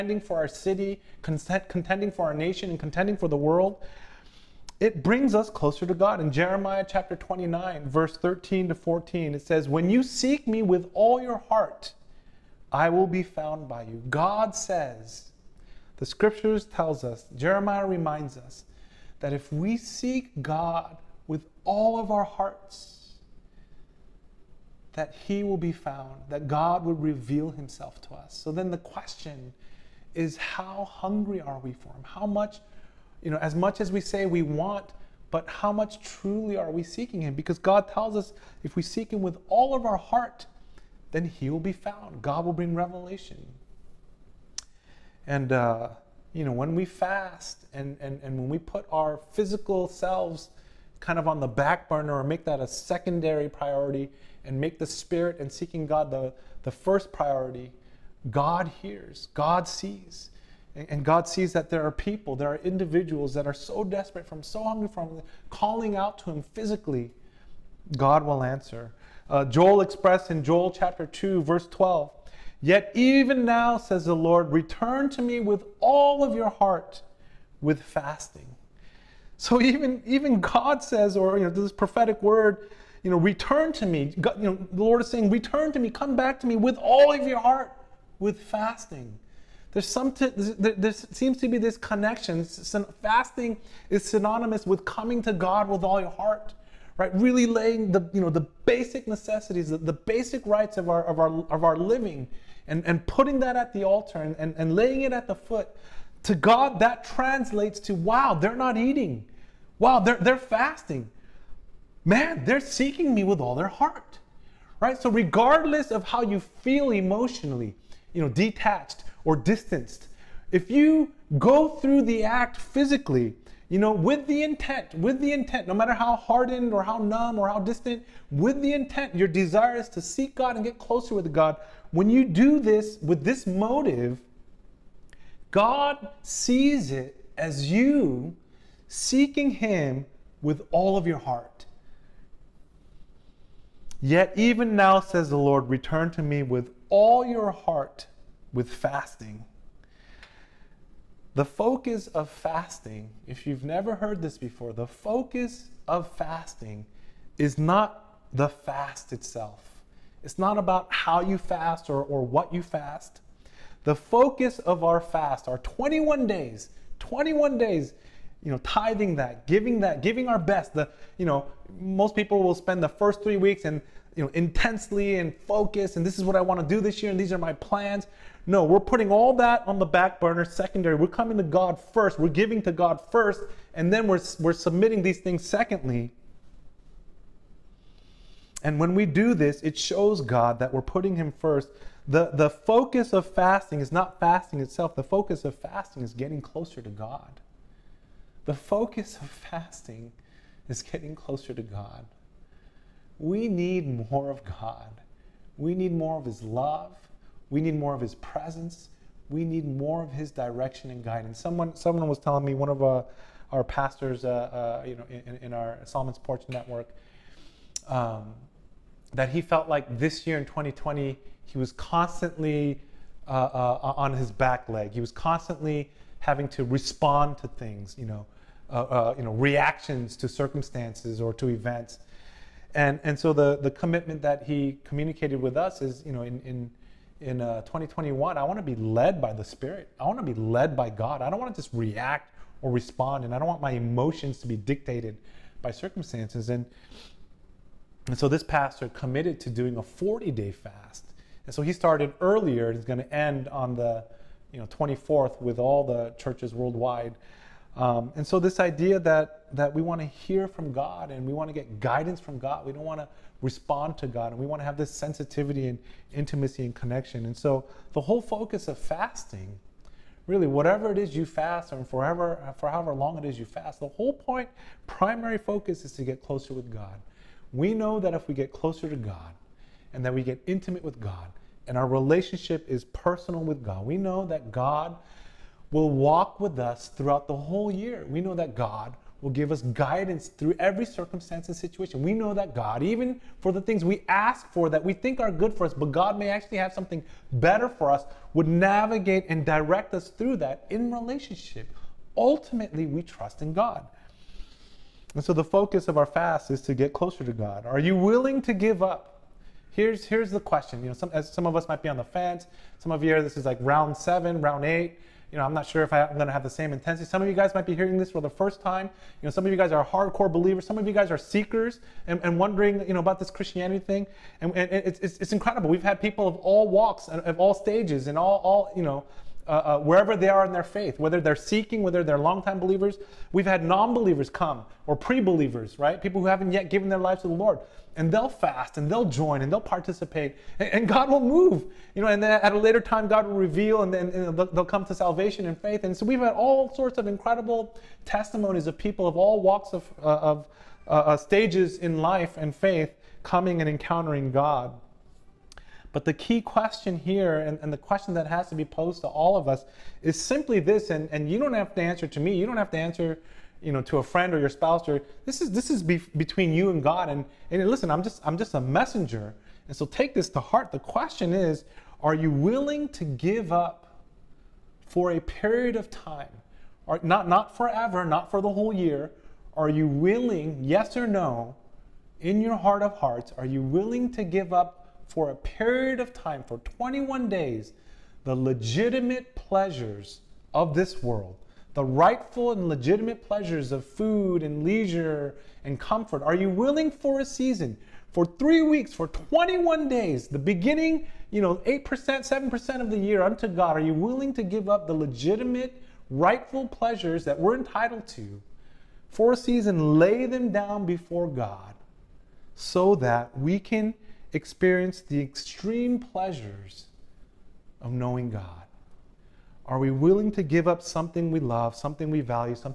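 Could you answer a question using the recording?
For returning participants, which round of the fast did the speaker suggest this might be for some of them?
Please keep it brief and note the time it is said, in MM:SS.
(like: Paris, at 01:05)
Round seven, at 05:13.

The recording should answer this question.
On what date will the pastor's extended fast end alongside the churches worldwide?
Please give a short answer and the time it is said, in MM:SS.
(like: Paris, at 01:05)
24th, at 04:14.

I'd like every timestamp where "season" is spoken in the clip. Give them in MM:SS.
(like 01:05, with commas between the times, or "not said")
06:37, 06:49.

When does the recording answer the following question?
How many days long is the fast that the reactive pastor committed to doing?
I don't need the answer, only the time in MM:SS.
04:09.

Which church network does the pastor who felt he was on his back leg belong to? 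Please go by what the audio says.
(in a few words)
Solomon's Porch Network.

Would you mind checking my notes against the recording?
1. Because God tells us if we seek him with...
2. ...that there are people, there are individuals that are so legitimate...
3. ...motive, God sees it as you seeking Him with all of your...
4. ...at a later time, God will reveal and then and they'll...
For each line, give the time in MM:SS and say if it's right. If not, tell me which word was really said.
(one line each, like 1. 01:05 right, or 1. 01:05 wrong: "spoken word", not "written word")
1. 00:37 right
2. 01:01 wrong: "desperate", not "legitimate"
3. 02:13 right
4. 05:42 right.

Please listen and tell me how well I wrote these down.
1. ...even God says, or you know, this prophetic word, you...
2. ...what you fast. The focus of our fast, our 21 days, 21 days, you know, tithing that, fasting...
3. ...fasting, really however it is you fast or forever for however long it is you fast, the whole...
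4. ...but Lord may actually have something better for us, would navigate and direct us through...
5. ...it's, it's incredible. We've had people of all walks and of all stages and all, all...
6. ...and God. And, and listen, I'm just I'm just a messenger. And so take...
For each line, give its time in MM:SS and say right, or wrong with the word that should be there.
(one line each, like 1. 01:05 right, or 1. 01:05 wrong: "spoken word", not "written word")
1. 01:20 right
2. 02:42 wrong: "giving", not "fasting"
3. 04:28 wrong: "whatever", not "however"
4. 04:55 wrong: "God", not "Lord"
5. 05:25 right
6. 06:06 right.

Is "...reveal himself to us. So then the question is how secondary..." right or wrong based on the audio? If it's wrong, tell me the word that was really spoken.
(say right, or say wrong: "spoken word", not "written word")
wrong: "hungry", not "secondary".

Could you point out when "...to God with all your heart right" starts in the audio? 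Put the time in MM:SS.
01:35.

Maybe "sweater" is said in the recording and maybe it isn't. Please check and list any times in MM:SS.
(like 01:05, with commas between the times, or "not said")
not said.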